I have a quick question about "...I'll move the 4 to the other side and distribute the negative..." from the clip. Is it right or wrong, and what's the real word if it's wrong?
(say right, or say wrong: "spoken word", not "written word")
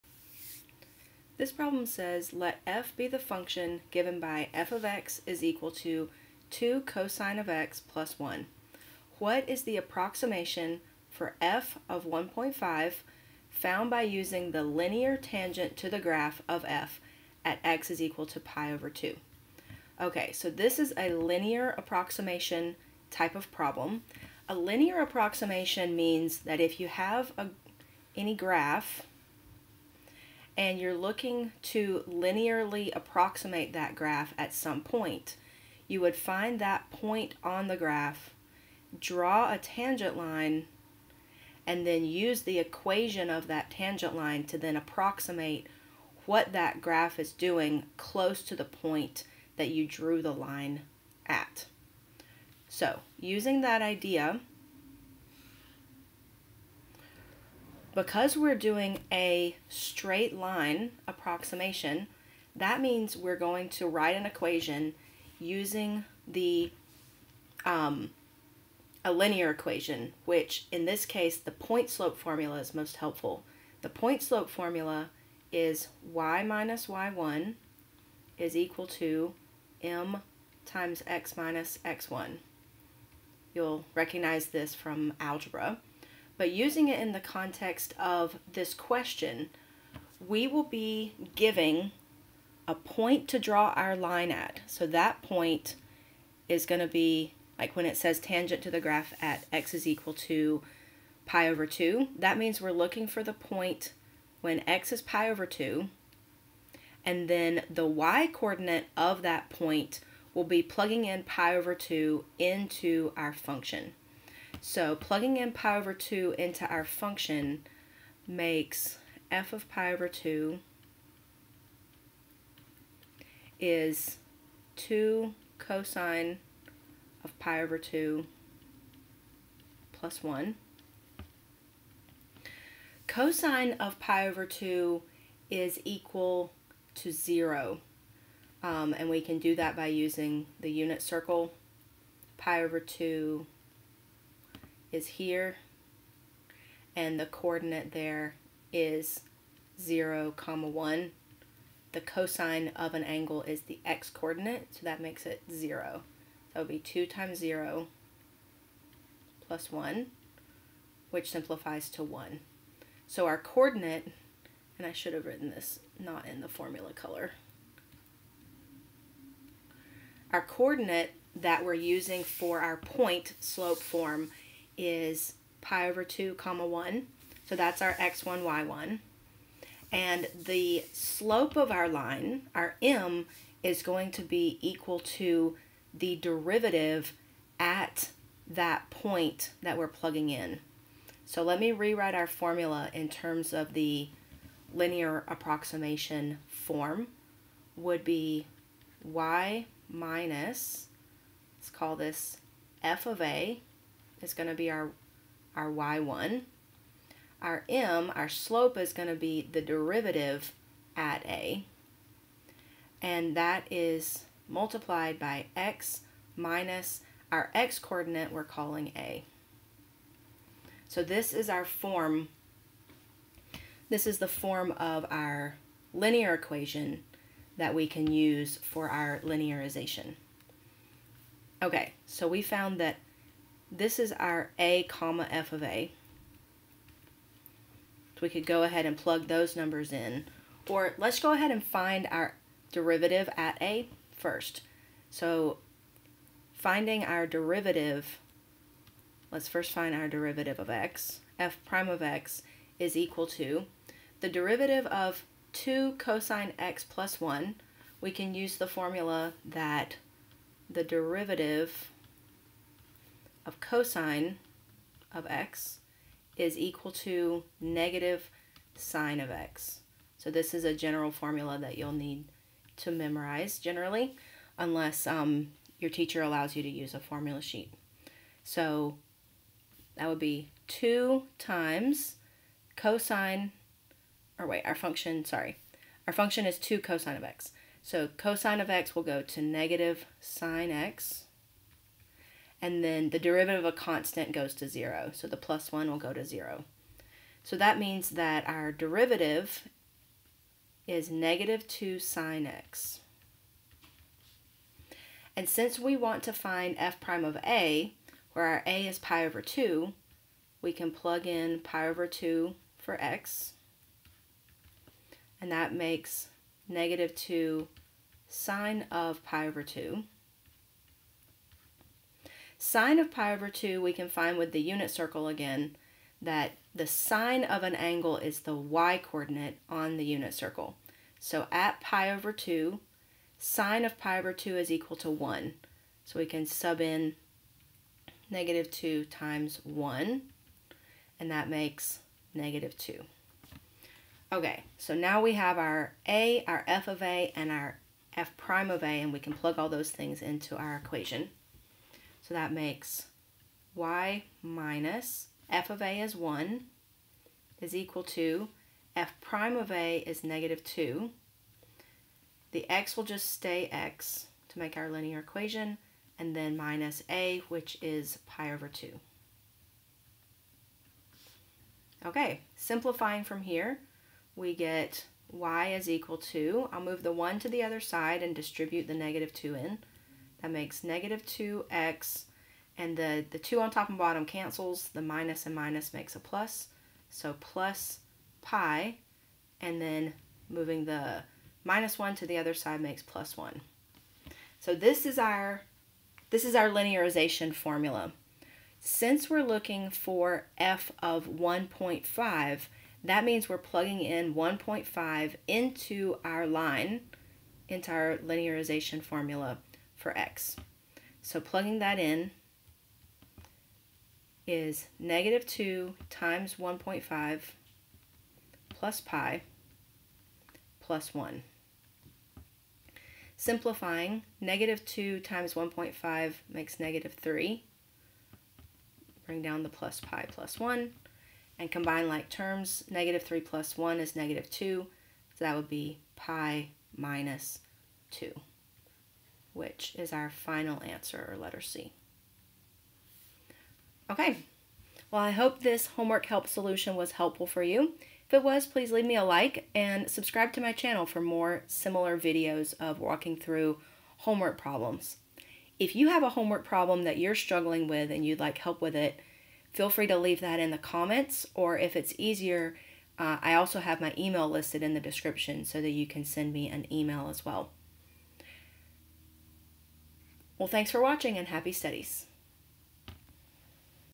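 wrong: "1", not "4".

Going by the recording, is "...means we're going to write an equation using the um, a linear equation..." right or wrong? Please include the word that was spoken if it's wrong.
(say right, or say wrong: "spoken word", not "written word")
right.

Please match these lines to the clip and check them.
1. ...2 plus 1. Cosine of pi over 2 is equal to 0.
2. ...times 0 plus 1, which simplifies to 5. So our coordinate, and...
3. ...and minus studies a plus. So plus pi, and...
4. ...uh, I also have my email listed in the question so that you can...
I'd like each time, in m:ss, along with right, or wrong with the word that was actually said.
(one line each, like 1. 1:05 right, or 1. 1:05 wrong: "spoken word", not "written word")
1. 2:07 right
2. 2:37 wrong: "1", not "5"
3. 6:25 wrong: "makes", not "studies"
4. 7:43 wrong: "description", not "question".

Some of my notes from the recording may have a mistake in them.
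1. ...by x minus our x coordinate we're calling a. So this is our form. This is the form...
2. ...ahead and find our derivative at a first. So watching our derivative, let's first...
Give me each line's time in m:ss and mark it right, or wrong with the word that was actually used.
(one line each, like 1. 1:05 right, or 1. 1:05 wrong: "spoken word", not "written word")
1. 3:35 right
2. 4:01 wrong: "finding", not "watching".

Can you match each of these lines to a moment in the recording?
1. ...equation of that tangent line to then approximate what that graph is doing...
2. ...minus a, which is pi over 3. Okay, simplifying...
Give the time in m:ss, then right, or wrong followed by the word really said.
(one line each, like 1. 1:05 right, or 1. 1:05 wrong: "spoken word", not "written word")
1. 0:42 right
2. 6:06 wrong: "2", not "3".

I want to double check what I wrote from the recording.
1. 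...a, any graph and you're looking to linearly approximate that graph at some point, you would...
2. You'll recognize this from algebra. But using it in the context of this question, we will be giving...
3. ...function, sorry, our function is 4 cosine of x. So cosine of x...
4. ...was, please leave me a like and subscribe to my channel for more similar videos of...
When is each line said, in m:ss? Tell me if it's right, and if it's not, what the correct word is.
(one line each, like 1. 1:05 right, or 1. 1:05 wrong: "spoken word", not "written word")
1. 0:27 right
2. 1:23 right
3. 4:44 wrong: "2", not "4"
4. 7:28 right.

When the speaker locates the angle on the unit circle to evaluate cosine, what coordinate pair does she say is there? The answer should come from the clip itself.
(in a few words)
0, 1.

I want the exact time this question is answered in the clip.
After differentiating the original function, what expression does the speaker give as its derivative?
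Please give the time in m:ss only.
5:01.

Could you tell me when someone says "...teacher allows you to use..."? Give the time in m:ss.
4:35.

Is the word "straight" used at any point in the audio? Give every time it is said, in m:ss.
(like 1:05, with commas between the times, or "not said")
0:59.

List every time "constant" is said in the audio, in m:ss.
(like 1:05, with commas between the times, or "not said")
4:53.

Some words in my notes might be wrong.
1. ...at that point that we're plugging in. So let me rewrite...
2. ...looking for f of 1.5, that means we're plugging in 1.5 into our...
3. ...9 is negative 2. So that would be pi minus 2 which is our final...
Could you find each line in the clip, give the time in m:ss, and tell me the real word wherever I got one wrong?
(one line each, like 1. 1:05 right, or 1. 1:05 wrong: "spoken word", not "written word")
1. 3:07 right
2. 6:39 right
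3. 7:13 wrong: "1", not "9".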